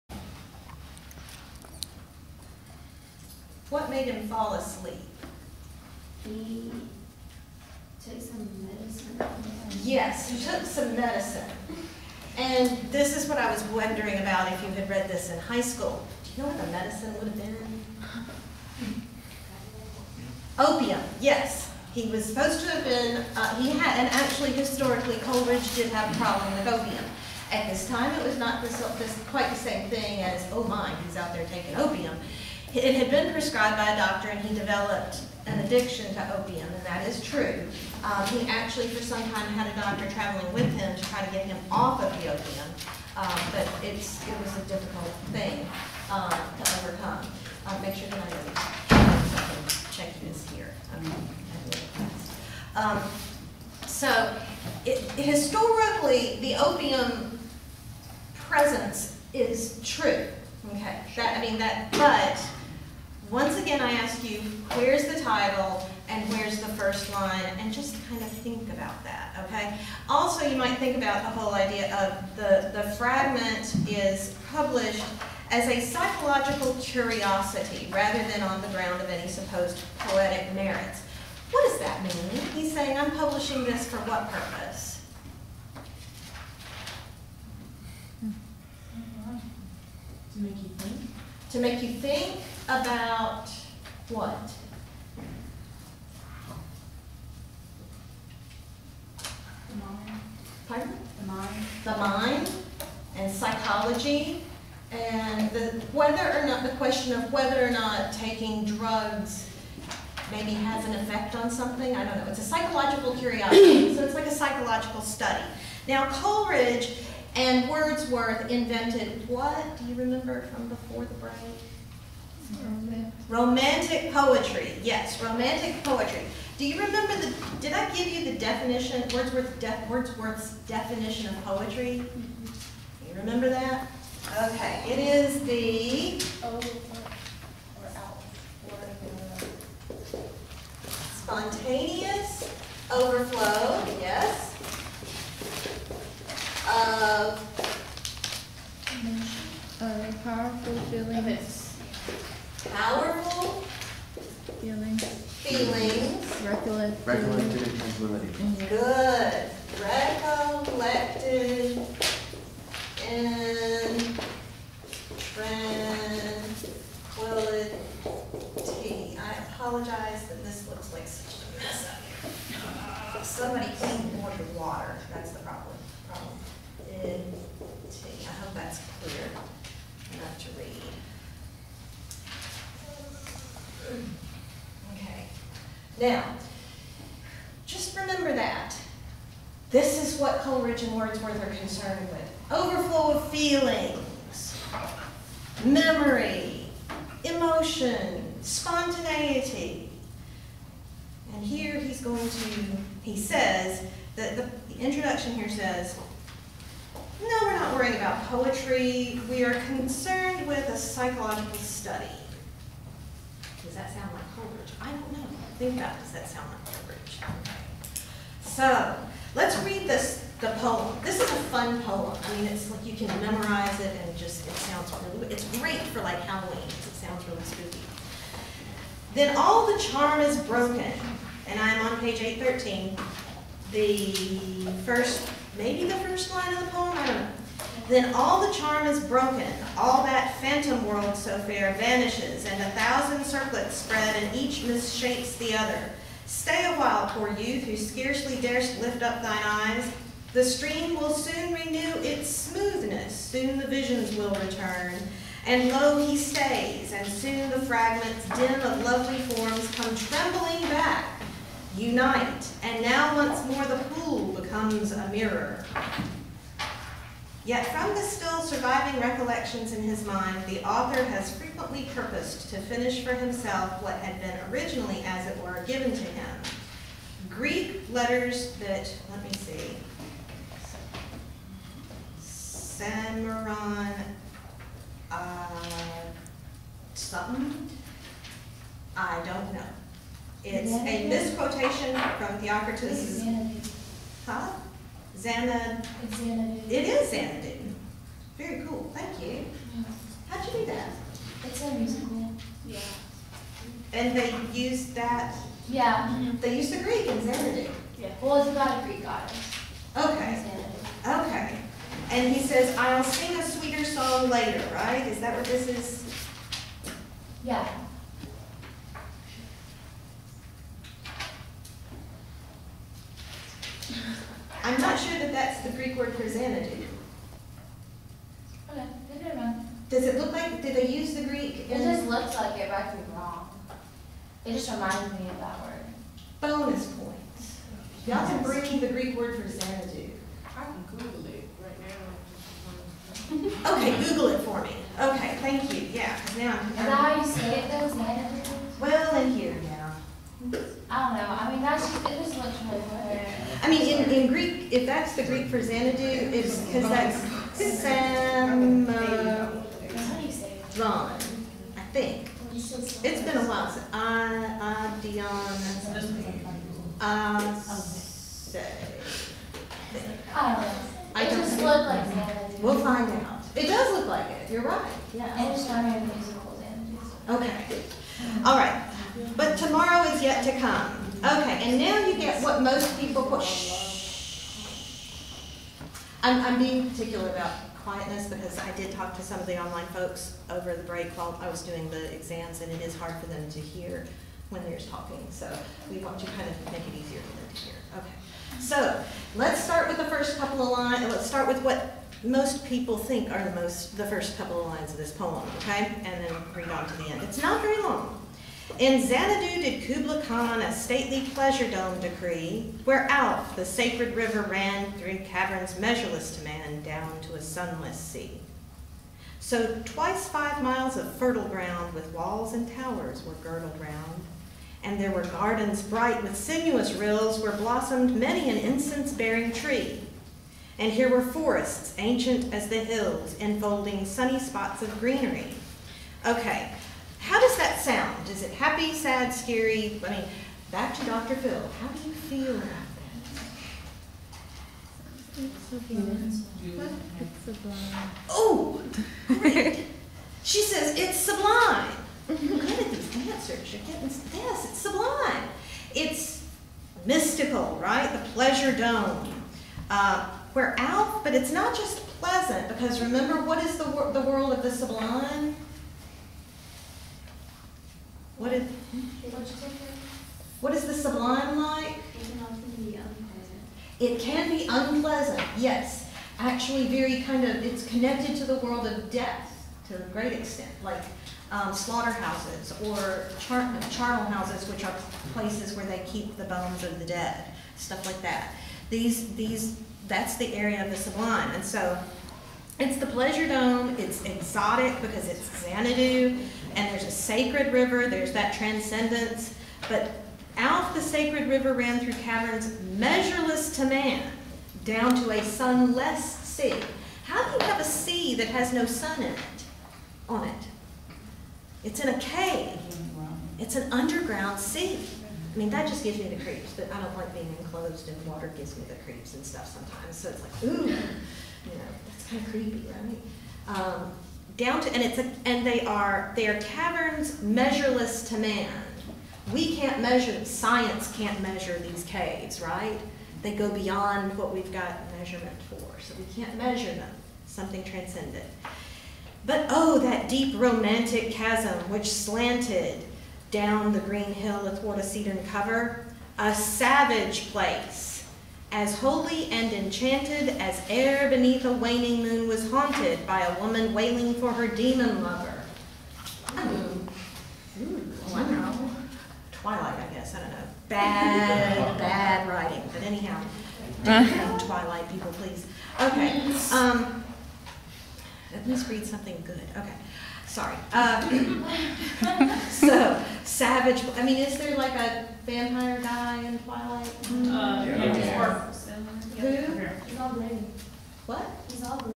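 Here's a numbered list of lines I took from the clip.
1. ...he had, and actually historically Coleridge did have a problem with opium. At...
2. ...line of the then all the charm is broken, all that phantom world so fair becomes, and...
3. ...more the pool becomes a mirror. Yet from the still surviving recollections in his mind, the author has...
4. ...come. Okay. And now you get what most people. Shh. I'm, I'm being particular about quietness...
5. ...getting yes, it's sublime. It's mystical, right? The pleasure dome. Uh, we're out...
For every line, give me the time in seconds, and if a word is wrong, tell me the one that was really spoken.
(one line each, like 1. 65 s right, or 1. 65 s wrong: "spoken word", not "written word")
1. 23 s right
2. 236 s wrong: "vanishes", not "becomes"
3. 263 s right
4. 380 s right
5. 453 s right.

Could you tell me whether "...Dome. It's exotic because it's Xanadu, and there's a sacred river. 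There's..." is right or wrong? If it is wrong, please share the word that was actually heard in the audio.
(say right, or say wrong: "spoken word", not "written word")
right.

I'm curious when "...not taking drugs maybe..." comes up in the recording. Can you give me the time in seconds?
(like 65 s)
107 s.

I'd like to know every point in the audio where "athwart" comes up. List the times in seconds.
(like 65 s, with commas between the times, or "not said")
544 s.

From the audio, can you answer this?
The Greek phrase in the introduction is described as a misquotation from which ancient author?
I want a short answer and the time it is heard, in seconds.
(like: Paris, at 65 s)
Theocritus, at 292 s.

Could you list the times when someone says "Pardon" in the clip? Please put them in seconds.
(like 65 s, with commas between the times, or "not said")
100 s.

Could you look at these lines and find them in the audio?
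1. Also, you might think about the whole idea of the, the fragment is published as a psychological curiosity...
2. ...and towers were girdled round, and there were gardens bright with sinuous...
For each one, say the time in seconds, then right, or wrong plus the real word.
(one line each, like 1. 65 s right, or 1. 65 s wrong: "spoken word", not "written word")
1. 70 s right
2. 422 s right.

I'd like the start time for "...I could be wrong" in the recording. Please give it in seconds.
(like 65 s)
332 s.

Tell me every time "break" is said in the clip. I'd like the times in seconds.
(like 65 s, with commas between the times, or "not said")
121 s, 390 s.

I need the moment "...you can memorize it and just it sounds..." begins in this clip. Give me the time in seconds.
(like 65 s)
222 s.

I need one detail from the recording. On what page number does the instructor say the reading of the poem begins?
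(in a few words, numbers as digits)
813.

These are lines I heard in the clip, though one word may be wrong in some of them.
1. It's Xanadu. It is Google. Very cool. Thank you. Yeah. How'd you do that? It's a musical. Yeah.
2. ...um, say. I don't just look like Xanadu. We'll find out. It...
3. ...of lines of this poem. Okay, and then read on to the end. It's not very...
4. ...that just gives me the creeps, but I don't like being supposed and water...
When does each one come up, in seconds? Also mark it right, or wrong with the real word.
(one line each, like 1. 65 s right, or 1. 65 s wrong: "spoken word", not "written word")
1. 296 s wrong: "Xanadu", not "Google"
2. 367 s right
3. 404 s right
4. 515 s wrong: "enclosed", not "supposed".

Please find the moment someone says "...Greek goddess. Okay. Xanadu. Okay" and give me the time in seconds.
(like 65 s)
308 s.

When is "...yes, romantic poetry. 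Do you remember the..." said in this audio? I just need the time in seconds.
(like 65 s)
124 s.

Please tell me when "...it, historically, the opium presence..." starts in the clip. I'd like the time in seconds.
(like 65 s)
54 s.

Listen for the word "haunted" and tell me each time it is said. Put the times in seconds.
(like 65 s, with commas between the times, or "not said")
552 s.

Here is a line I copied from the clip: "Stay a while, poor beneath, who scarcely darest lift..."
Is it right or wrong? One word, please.
wrong.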